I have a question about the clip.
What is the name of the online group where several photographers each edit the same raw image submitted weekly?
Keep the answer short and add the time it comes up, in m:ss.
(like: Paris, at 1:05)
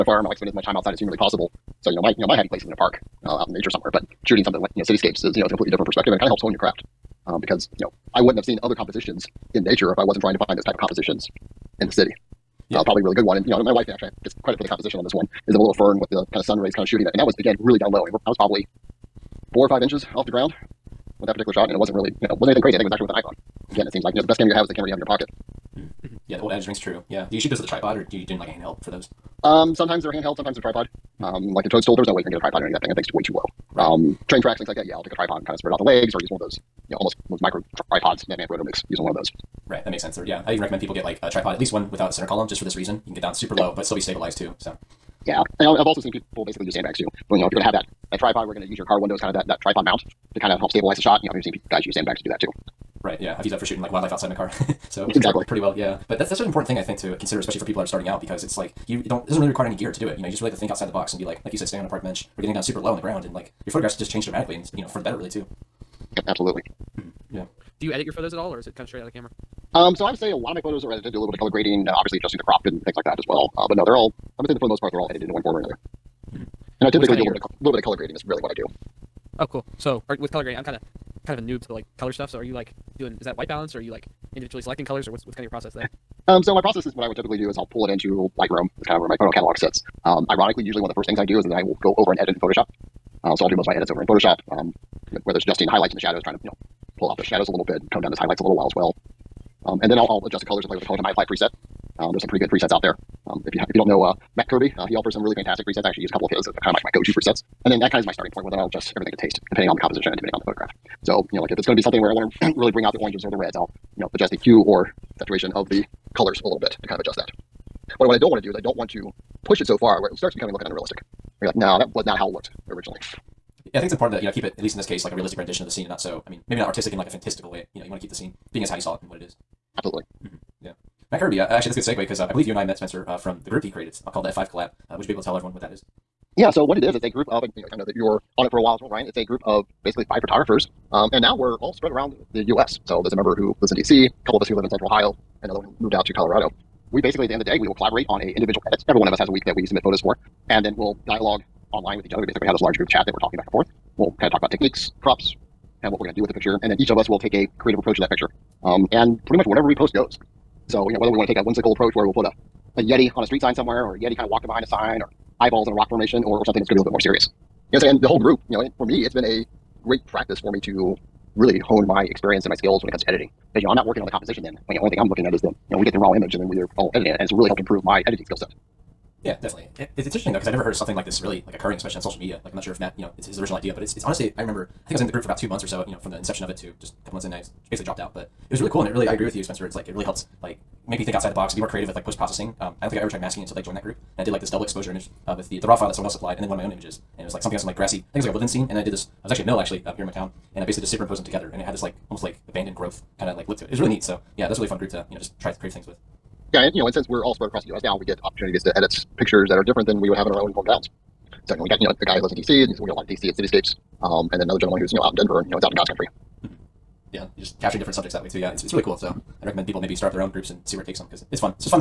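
F5 Collab, at 2:14.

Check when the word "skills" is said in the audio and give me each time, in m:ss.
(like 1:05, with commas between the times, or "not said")
2:52, 2:58.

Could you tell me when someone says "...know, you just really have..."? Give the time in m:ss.
1:00.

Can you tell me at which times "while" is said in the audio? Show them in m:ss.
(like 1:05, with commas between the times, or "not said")
1:38, 2:18.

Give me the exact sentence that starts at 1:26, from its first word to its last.
Um, so my process is what I would typically do is I'll pull it into Lightroom.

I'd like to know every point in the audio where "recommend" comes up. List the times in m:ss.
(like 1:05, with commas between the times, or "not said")
0:40, 3:39.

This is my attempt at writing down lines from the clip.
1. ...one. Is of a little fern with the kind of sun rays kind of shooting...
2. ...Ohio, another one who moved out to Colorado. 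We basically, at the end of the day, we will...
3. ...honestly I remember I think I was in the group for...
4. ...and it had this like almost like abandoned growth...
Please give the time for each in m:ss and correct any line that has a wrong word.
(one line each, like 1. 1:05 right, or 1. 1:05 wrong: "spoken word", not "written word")
1. 0:15 right
2. 2:24 right
3. 3:04 right
4. 3:21 right.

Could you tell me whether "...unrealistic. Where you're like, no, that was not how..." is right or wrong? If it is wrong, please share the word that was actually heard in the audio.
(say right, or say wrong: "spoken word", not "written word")
right.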